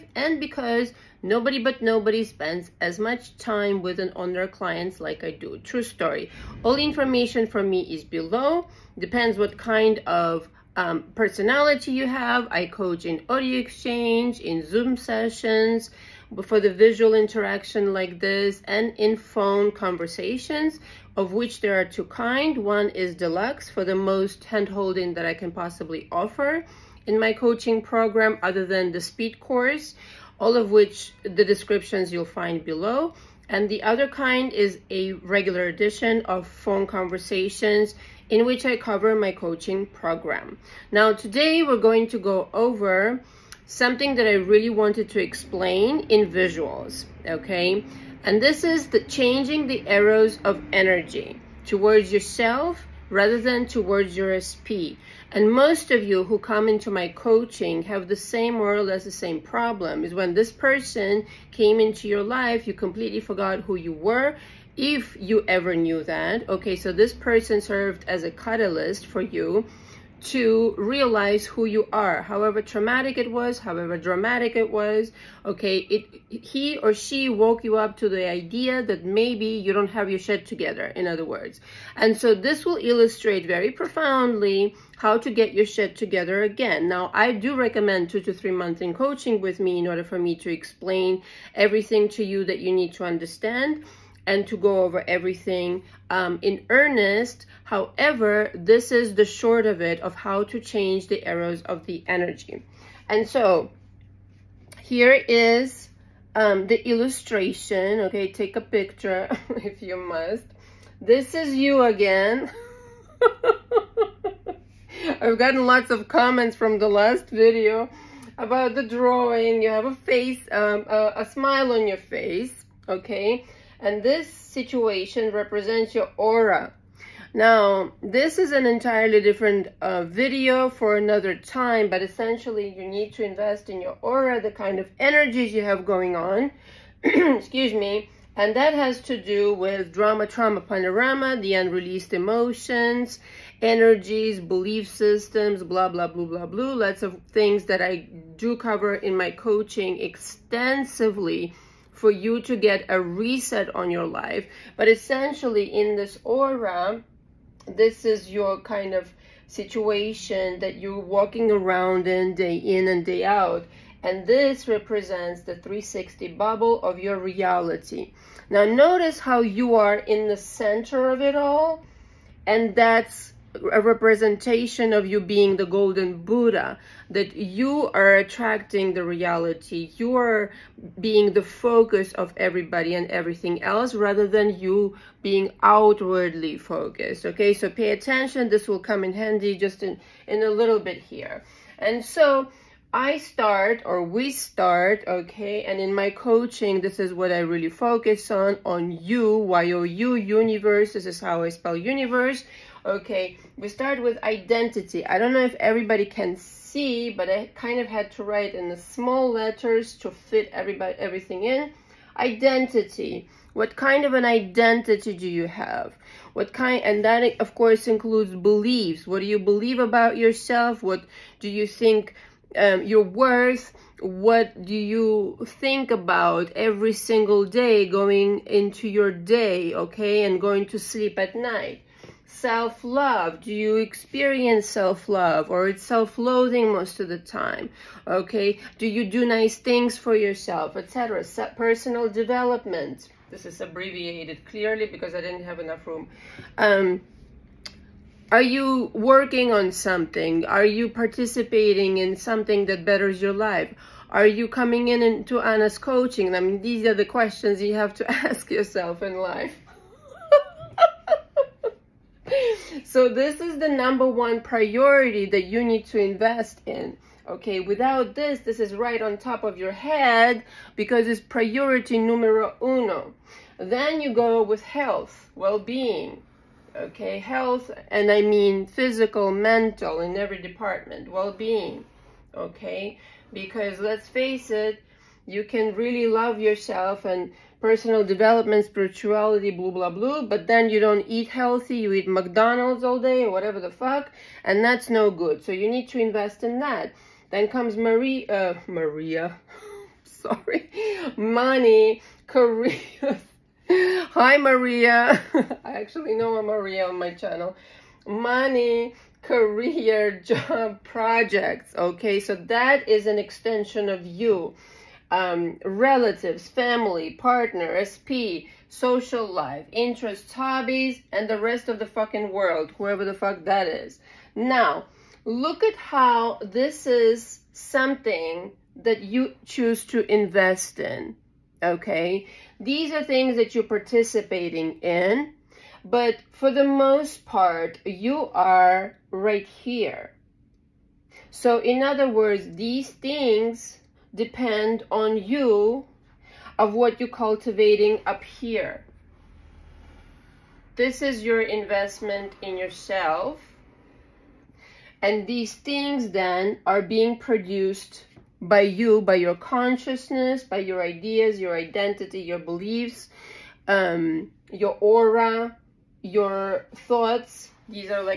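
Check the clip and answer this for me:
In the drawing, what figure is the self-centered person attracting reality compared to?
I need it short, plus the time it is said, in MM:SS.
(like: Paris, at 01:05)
golden Buddha, at 02:55.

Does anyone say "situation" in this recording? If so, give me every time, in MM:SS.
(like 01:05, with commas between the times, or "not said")
02:04, 02:39.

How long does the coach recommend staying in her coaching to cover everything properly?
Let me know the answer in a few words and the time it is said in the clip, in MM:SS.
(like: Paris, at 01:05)
2 to 3 months, at 01:28.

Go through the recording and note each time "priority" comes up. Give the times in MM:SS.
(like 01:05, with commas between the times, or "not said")
04:24, 04:31.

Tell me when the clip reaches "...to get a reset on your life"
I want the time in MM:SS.
02:32.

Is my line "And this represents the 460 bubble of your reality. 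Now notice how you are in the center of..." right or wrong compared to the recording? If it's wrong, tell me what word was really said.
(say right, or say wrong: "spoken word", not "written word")
wrong: "360", not "460".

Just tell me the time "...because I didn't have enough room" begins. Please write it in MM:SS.
04:04.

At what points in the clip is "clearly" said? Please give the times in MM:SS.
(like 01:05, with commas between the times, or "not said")
04:04.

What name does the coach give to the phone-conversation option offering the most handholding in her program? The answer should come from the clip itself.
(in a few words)
deluxe.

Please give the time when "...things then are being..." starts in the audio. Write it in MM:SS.
05:55.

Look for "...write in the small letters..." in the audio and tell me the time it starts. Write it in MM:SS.
03:28.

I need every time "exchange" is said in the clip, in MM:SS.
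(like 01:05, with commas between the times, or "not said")
00:13.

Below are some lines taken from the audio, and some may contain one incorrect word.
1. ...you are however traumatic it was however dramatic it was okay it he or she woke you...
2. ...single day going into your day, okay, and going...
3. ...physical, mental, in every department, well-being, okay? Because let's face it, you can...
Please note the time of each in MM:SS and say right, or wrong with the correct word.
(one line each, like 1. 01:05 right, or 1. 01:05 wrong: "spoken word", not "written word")
1. 01:11 right
2. 03:46 right
3. 04:38 right.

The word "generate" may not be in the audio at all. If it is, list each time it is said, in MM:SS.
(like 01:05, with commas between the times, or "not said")
not said.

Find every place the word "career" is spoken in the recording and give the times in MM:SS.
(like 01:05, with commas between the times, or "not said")
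05:02, 05:09.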